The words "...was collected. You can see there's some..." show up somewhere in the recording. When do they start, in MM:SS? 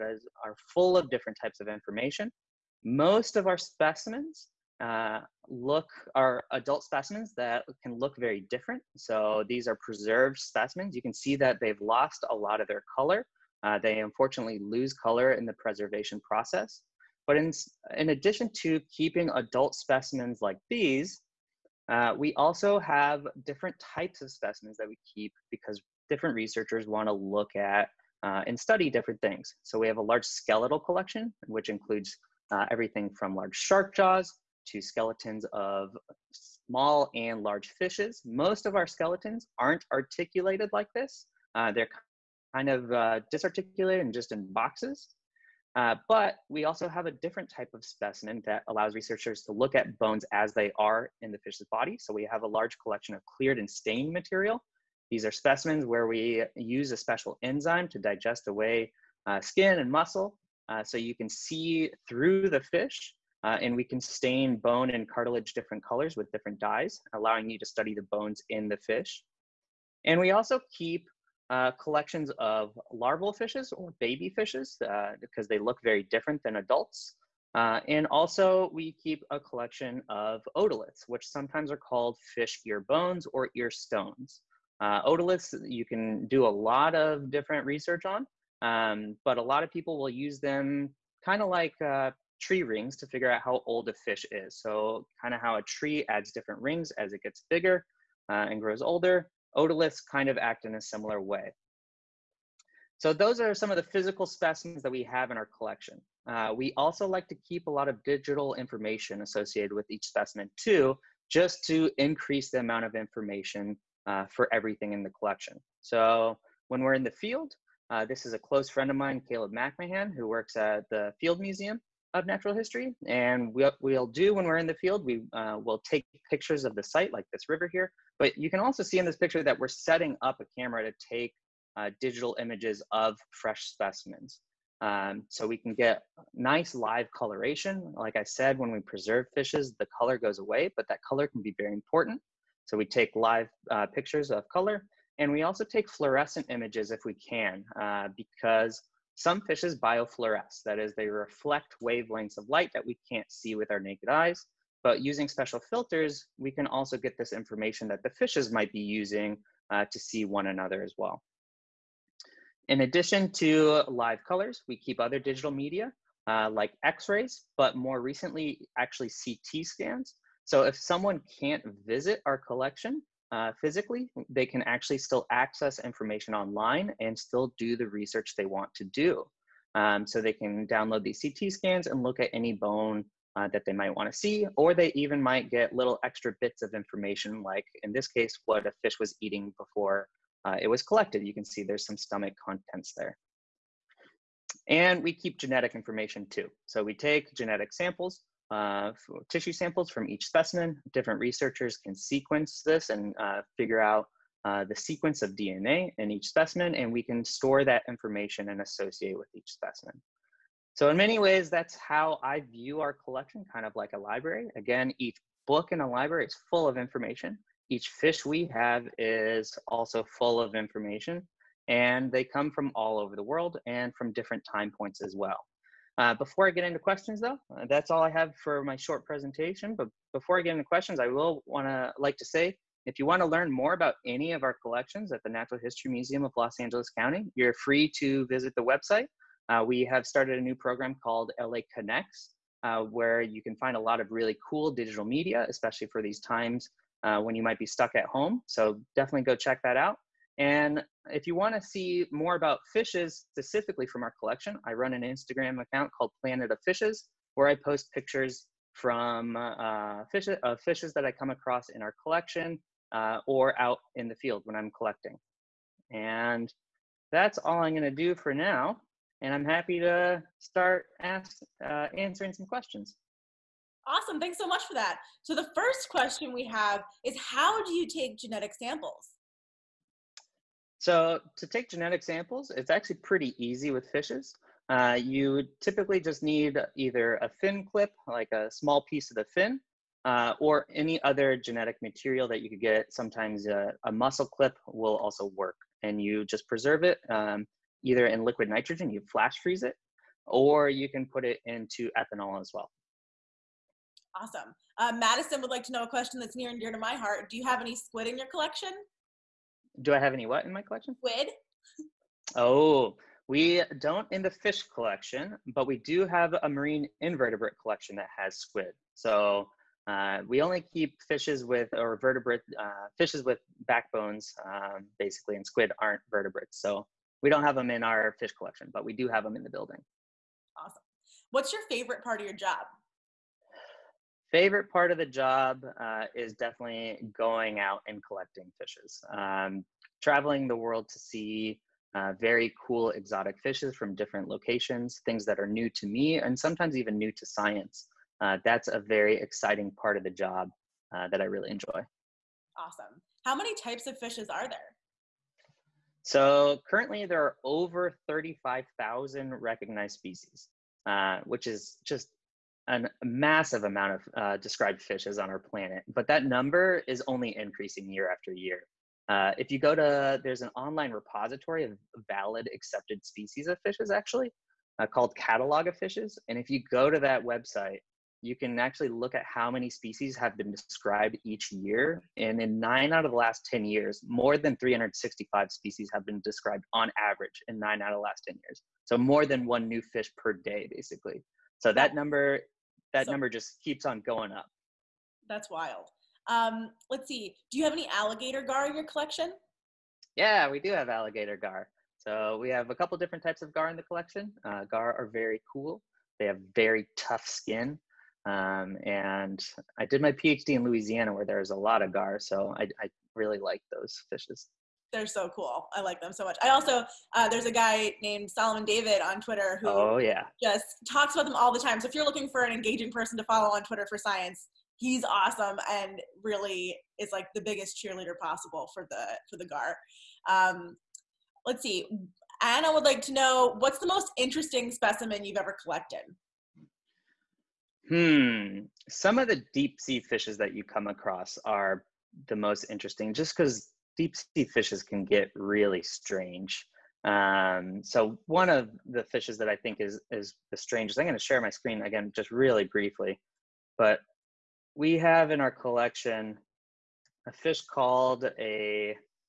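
03:10.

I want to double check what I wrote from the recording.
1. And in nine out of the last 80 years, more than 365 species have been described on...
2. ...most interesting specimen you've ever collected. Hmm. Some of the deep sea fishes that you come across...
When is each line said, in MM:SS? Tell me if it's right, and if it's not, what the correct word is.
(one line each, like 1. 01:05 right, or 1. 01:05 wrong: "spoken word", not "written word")
1. 06:22 wrong: "10", not "80"
2. 07:13 right.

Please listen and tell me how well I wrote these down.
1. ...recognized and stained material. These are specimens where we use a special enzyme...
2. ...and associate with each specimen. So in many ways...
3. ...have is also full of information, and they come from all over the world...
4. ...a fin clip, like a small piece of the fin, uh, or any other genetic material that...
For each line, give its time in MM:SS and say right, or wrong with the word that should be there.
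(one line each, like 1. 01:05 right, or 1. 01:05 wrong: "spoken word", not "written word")
1. 00:53 wrong: "cleared", not "recognized"
2. 03:28 right
3. 03:38 right
4. 04:47 right.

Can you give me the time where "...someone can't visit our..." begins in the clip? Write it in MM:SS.
02:50.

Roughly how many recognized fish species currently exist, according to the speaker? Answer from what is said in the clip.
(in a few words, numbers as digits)
over 35,000.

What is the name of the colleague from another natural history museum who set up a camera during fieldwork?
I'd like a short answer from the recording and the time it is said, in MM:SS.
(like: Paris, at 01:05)
Caleb McMahon, at 01:59.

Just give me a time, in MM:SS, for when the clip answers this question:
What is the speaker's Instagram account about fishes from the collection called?
04:16.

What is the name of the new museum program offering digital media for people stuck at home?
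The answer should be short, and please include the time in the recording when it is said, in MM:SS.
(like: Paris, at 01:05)
LA Connects, at 04:01.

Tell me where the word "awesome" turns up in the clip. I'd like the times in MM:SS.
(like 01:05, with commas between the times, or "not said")
04:33, 05:04, 05:30, 05:52, 07:05.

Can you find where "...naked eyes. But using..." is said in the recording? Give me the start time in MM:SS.
02:33.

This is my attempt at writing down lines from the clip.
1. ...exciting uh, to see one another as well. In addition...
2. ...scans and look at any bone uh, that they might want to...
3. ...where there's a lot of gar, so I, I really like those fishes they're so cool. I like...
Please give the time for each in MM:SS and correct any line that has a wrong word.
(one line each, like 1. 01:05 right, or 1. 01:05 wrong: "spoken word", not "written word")
1. 02:38 wrong: "using", not "exciting"
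2. 03:01 right
3. 06:51 right.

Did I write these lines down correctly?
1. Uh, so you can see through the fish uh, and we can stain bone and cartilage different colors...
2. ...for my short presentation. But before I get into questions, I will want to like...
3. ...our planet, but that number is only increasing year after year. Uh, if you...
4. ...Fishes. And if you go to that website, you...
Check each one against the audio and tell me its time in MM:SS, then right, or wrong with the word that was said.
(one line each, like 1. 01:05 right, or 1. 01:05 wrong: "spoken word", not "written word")
1. 01:00 right
2. 03:48 right
3. 06:05 right
4. 06:15 right.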